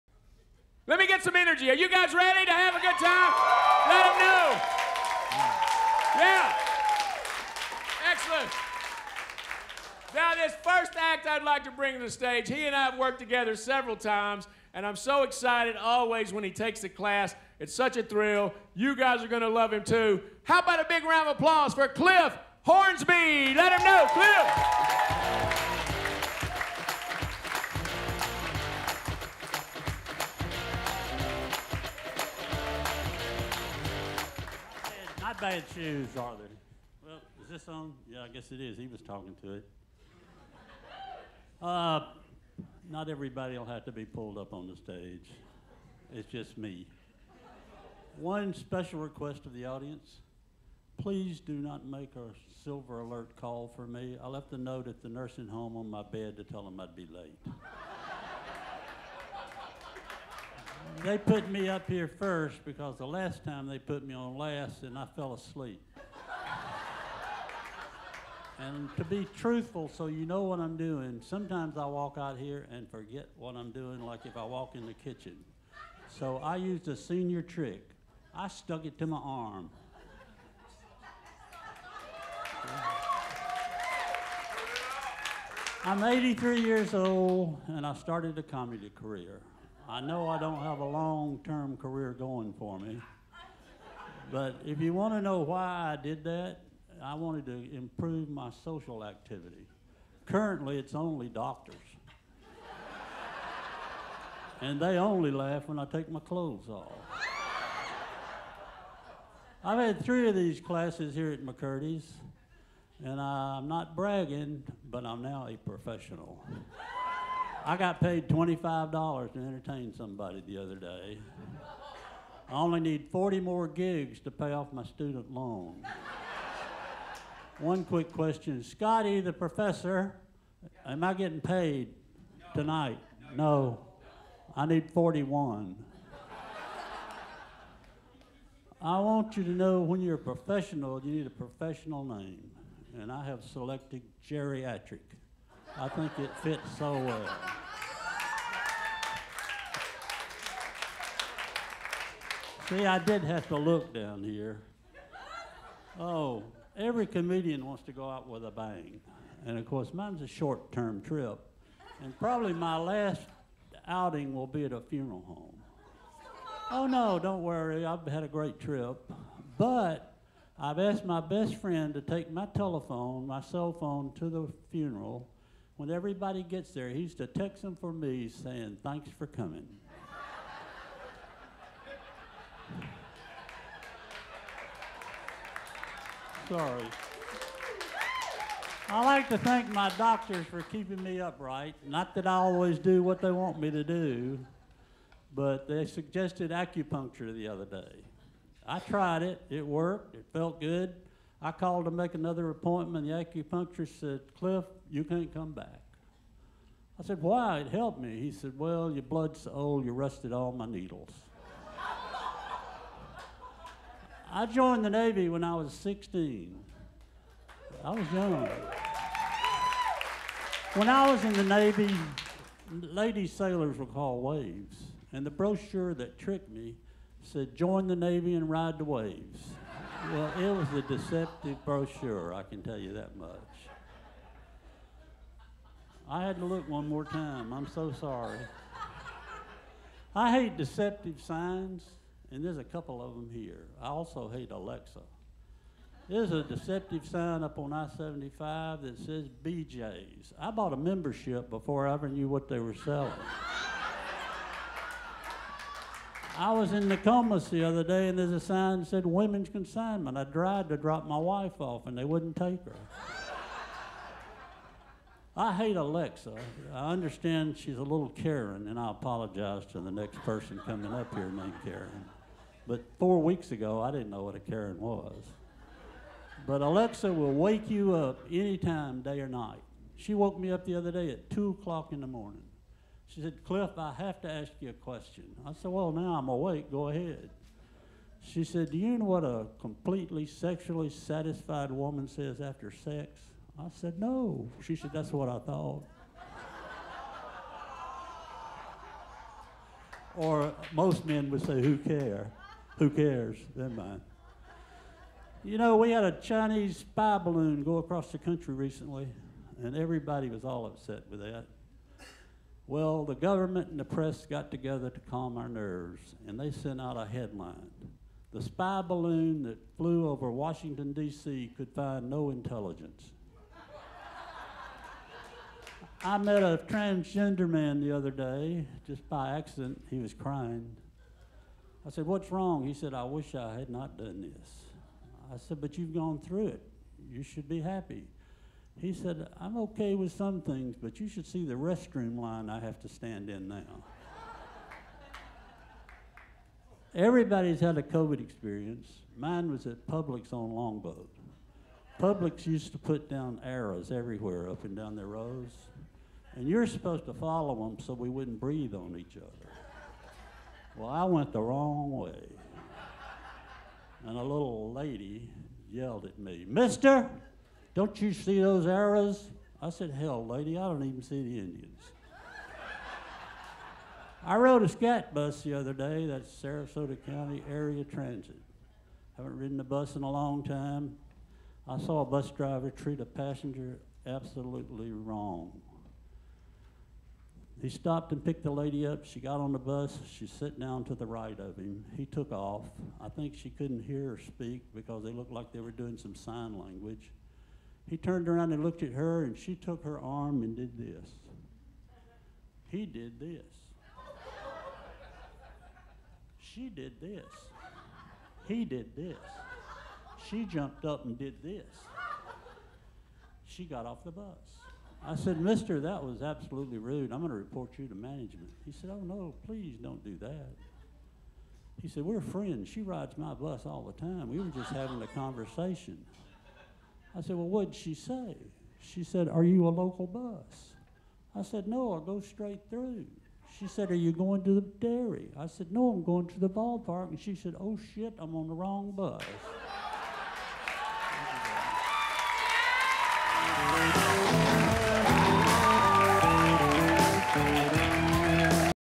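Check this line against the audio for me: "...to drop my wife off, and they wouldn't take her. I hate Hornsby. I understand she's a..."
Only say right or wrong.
wrong.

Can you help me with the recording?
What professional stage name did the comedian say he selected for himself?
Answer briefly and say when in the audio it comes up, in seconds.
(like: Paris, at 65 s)
Gerryatrick, at 144 s.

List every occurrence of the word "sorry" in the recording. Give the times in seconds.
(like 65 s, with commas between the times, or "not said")
186 s, 237 s.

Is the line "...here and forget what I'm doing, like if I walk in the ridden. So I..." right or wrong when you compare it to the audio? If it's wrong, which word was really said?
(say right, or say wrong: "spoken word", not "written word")
wrong: "kitchen", not "ridden".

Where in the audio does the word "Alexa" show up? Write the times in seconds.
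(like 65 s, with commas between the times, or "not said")
244 s, 265 s, 276 s.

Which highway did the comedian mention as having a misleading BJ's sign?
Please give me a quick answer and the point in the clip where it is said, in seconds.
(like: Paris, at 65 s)
I 75, at 247 s.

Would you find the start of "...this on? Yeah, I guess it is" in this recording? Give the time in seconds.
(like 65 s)
37 s.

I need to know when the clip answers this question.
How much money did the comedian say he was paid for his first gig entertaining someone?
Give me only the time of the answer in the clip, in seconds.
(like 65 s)
118 s.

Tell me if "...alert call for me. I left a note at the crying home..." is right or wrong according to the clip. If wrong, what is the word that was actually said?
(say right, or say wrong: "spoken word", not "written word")
wrong: "nursing", not "crying".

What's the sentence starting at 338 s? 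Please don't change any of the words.
He said, I'm okay with some things, but you should see the restroom line I have to stand in now.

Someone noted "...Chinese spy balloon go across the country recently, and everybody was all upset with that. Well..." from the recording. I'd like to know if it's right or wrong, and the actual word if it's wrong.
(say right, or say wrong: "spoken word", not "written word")
right.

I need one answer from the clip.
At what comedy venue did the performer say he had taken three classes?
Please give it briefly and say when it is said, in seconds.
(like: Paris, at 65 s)
McCurdy's, at 111 s.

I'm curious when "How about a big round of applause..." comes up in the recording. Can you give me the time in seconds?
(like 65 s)
20 s.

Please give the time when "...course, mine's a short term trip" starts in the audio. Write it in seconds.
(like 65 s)
159 s.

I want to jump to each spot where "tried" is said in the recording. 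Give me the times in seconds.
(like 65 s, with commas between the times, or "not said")
198 s, 260 s.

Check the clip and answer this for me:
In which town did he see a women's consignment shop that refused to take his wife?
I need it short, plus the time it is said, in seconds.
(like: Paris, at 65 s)
Nokomis, at 256 s.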